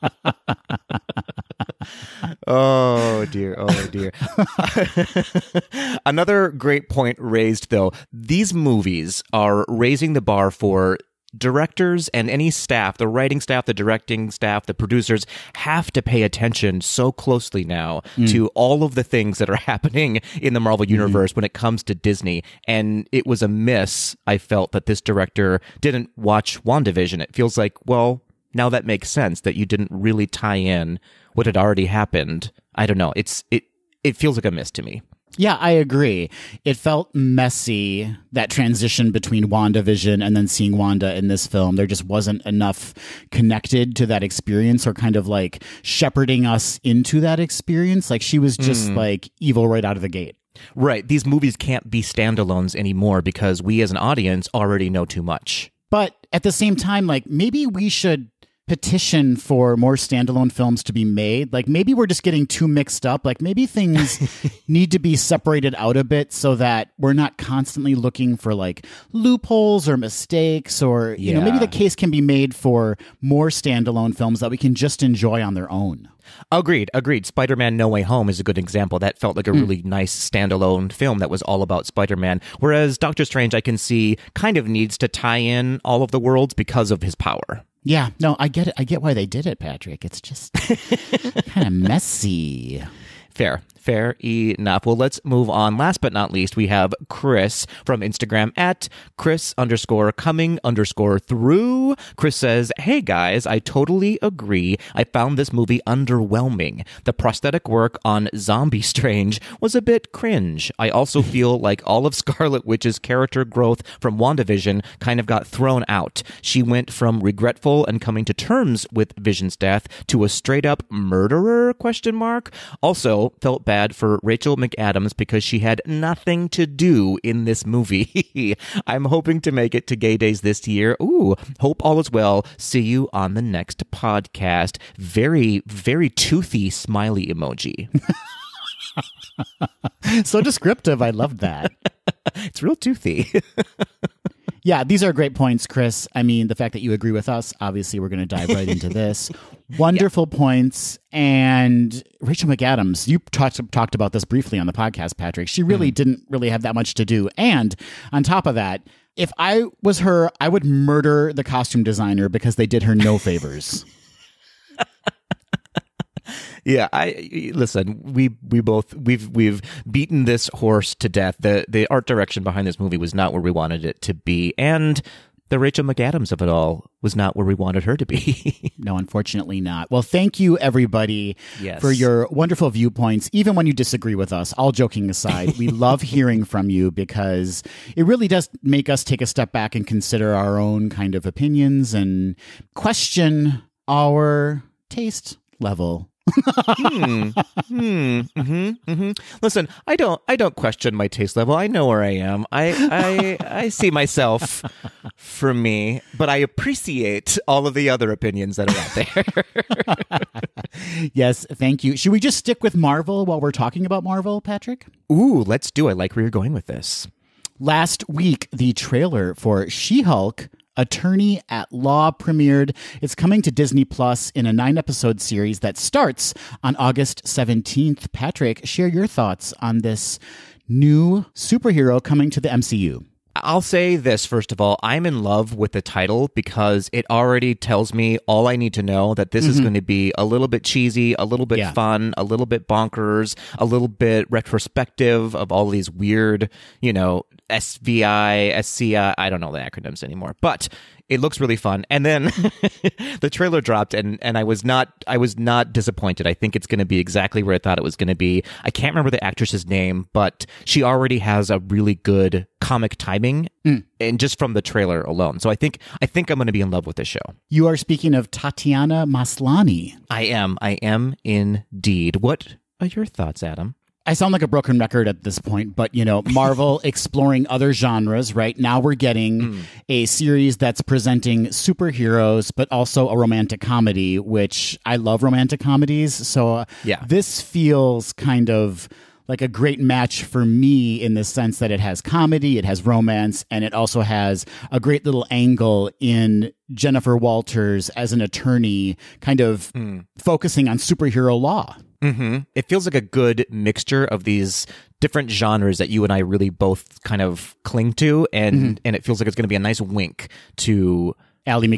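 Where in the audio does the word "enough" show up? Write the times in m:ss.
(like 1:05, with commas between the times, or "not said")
0:42, 1:34.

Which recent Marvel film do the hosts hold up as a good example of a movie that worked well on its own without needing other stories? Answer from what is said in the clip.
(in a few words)
Spider Man No Way Home.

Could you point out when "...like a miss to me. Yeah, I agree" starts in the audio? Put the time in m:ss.
0:34.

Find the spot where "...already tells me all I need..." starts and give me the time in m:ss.
3:57.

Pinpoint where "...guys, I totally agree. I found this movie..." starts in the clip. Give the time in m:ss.
1:43.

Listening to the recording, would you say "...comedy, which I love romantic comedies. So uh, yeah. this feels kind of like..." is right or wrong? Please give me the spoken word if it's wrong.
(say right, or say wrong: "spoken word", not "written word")
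right.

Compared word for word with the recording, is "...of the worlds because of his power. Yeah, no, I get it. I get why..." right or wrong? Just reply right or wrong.
right.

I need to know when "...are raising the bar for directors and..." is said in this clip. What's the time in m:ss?
0:09.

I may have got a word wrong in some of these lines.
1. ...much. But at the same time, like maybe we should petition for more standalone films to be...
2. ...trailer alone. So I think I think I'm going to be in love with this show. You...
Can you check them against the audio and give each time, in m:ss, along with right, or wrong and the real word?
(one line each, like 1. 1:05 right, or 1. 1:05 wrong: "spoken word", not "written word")
1. 0:55 right
2. 4:24 right.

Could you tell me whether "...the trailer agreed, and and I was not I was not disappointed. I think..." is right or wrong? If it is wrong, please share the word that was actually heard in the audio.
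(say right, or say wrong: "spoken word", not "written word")
wrong: "dropped", not "agreed".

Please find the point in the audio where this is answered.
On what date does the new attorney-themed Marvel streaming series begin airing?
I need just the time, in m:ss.
3:46.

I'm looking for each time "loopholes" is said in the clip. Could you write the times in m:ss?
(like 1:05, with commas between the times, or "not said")
1:09.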